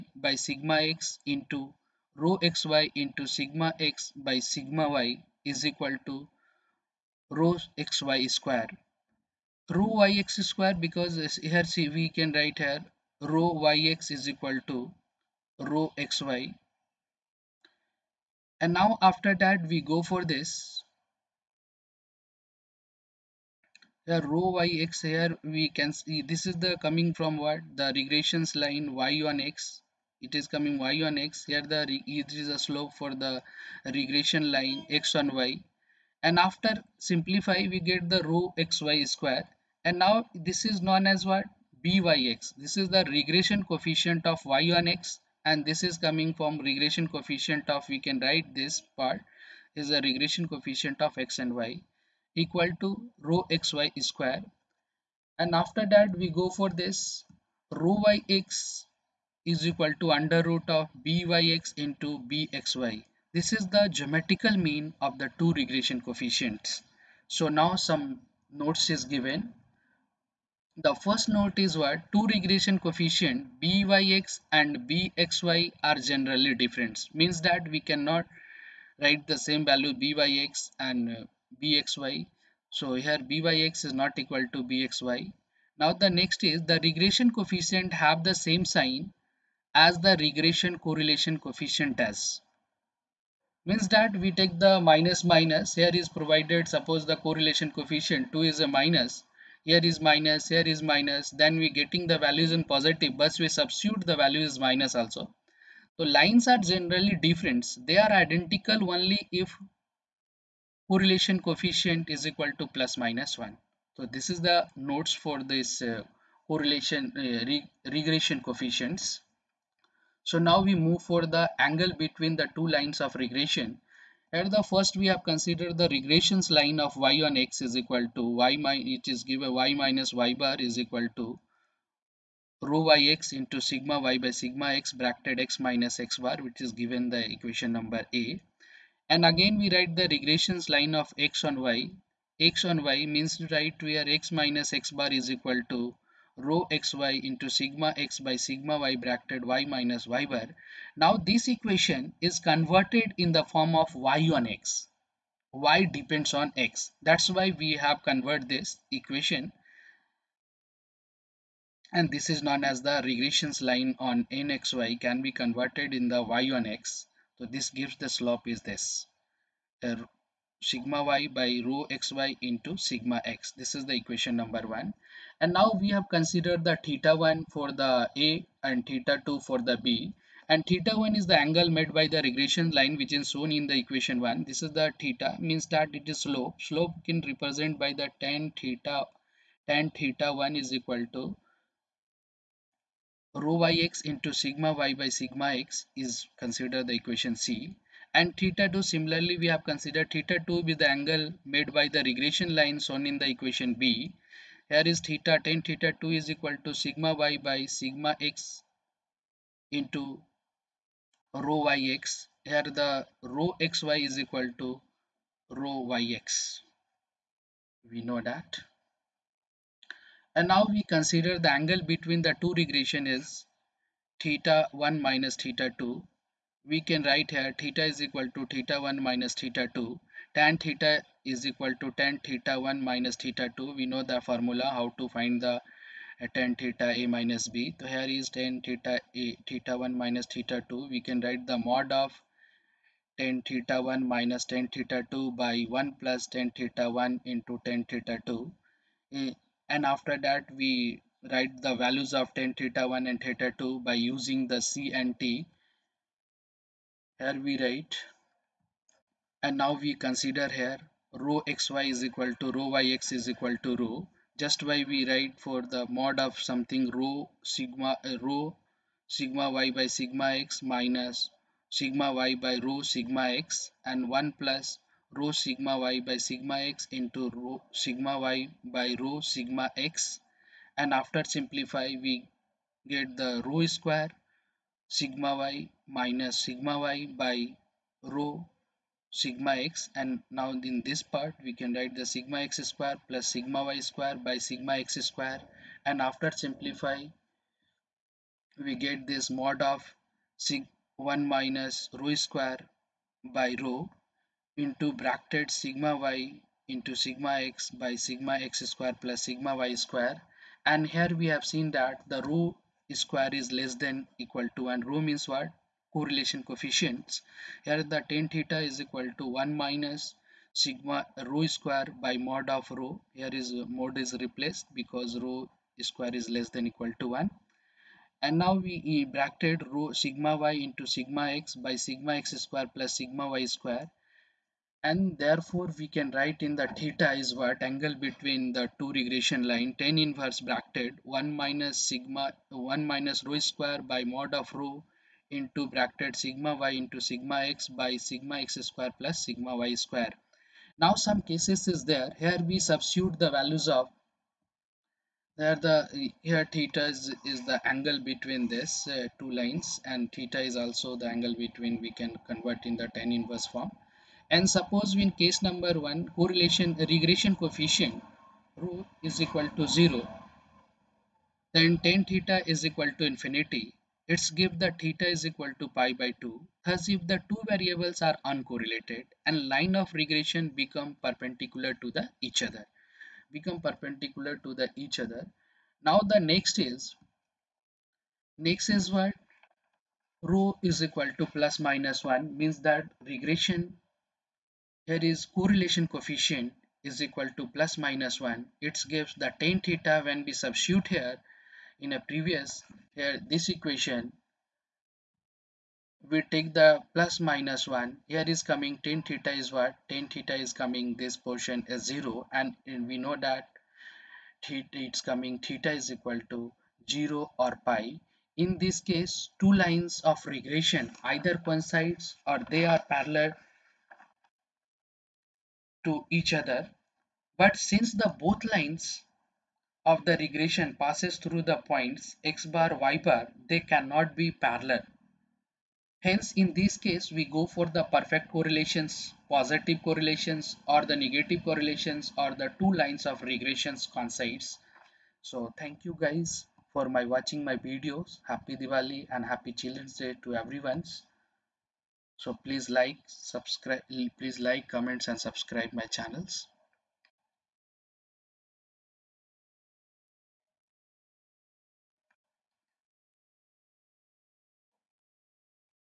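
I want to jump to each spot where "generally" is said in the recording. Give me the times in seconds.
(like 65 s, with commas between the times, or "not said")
75 s, 106 s.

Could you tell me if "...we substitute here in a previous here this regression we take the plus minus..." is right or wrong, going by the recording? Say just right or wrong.
wrong.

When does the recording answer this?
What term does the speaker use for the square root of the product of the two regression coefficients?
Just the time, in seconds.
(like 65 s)
63 s.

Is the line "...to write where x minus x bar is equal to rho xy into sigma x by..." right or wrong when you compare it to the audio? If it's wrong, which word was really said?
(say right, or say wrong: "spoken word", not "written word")
right.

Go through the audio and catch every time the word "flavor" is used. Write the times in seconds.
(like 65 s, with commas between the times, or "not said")
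not said.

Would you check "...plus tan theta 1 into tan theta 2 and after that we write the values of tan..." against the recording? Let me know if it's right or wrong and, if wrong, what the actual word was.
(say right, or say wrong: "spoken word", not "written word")
right.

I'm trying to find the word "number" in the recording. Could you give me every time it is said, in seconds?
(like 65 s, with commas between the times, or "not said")
137 s, 174 s, 365 s.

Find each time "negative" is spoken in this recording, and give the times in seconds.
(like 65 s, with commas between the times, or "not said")
440 s.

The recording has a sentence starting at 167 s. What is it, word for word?
So this gives the slope is this.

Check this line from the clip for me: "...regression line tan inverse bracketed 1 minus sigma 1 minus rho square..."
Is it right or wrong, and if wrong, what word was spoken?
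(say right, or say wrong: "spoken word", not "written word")
right.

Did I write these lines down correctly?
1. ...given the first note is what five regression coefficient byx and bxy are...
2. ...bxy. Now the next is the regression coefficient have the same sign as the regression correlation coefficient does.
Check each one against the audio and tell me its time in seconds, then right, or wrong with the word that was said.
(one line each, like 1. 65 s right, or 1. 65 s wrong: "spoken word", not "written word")
1. 69 s wrong: "two", not "five"
2. 84 s right.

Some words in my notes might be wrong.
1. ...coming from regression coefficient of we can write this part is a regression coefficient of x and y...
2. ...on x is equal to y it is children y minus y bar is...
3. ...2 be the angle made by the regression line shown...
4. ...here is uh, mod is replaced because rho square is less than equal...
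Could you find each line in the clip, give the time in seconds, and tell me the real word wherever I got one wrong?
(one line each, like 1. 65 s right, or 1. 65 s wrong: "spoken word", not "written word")
1. 45 s right
2. 127 s wrong: "given", not "children"
3. 200 s right
4. 323 s right.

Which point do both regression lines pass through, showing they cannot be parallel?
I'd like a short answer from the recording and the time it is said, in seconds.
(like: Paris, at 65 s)
x bar, y bar, at 432 s.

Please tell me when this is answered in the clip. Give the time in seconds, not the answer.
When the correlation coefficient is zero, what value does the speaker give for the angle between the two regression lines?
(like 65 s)
375 s.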